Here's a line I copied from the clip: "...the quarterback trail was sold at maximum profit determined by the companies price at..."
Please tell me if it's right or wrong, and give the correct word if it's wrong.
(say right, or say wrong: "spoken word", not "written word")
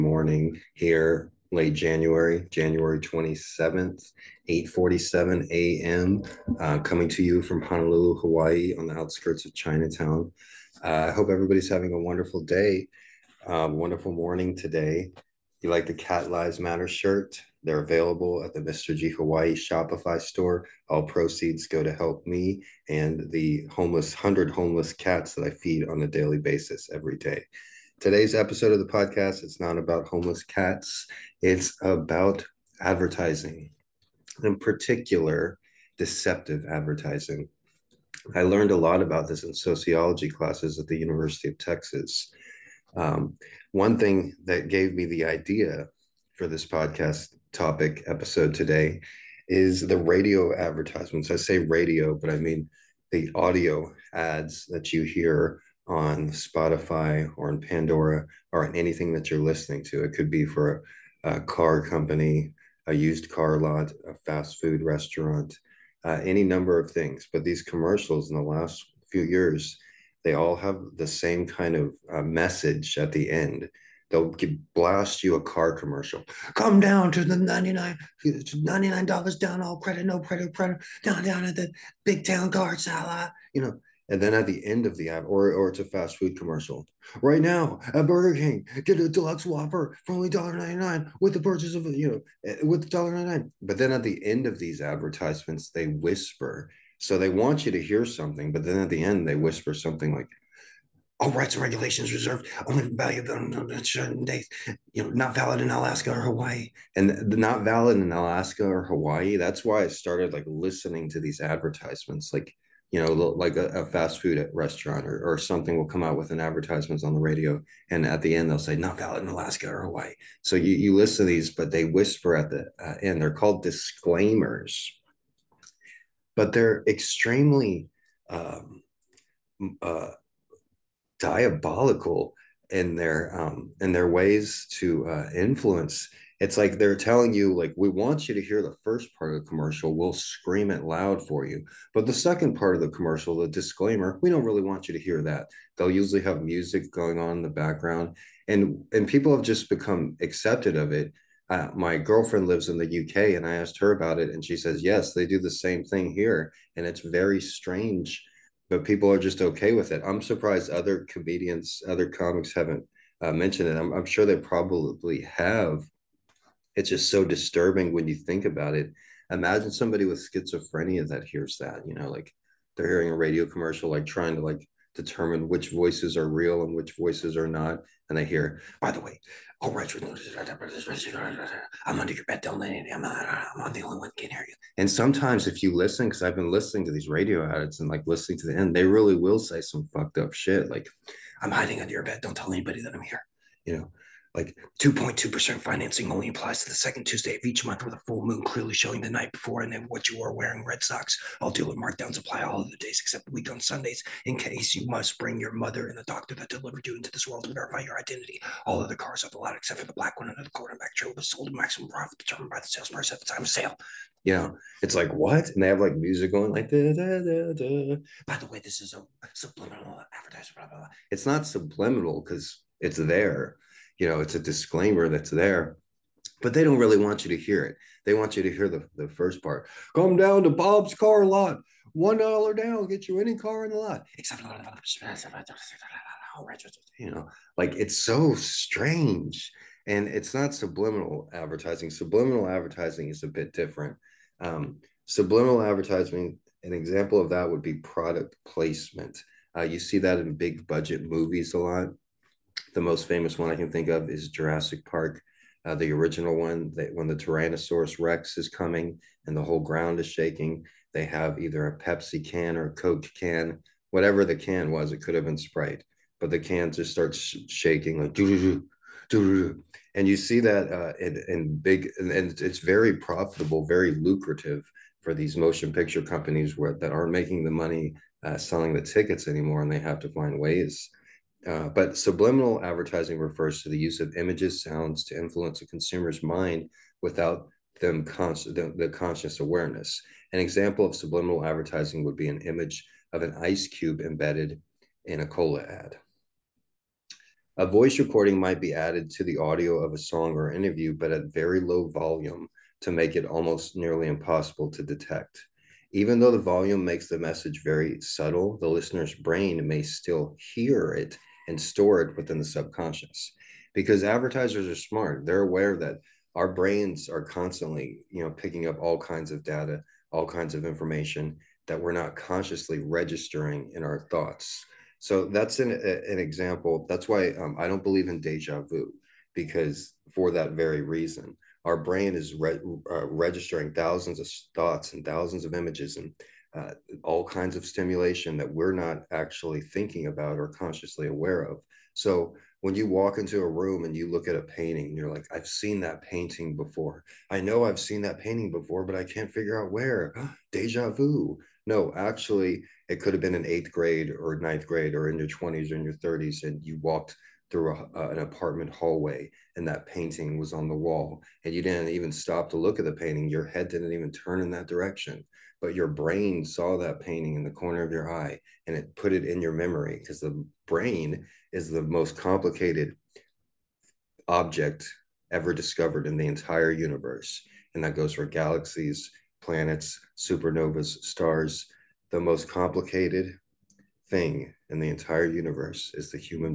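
wrong: "sales", not "companies".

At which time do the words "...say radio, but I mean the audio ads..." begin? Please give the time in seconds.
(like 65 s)
51 s.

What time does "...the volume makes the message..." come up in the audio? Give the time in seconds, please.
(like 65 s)
306 s.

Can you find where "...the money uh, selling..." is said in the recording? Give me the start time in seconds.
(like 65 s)
277 s.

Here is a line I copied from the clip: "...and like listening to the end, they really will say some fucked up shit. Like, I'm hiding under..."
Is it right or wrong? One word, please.
right.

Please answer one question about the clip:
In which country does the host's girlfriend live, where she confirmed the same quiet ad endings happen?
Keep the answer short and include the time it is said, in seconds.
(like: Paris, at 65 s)
UK, at 153 s.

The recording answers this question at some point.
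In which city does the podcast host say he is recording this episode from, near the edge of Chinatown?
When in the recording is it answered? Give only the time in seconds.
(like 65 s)
7 s.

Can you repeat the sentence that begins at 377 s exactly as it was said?
And that goes for galaxies, planets, supernovas, stars.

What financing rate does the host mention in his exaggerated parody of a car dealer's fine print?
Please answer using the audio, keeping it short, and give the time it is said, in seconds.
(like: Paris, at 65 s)
2.2%, at 194 s.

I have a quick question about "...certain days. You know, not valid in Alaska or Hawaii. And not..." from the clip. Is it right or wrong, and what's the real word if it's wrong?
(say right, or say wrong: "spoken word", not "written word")
right.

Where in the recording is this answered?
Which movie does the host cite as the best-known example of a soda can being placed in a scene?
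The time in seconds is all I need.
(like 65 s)
254 s.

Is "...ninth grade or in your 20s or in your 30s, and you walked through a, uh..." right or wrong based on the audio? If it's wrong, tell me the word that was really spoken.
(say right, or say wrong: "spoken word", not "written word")
right.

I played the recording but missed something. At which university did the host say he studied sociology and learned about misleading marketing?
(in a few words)
University of Texas.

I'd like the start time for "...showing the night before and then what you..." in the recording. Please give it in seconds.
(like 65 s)
198 s.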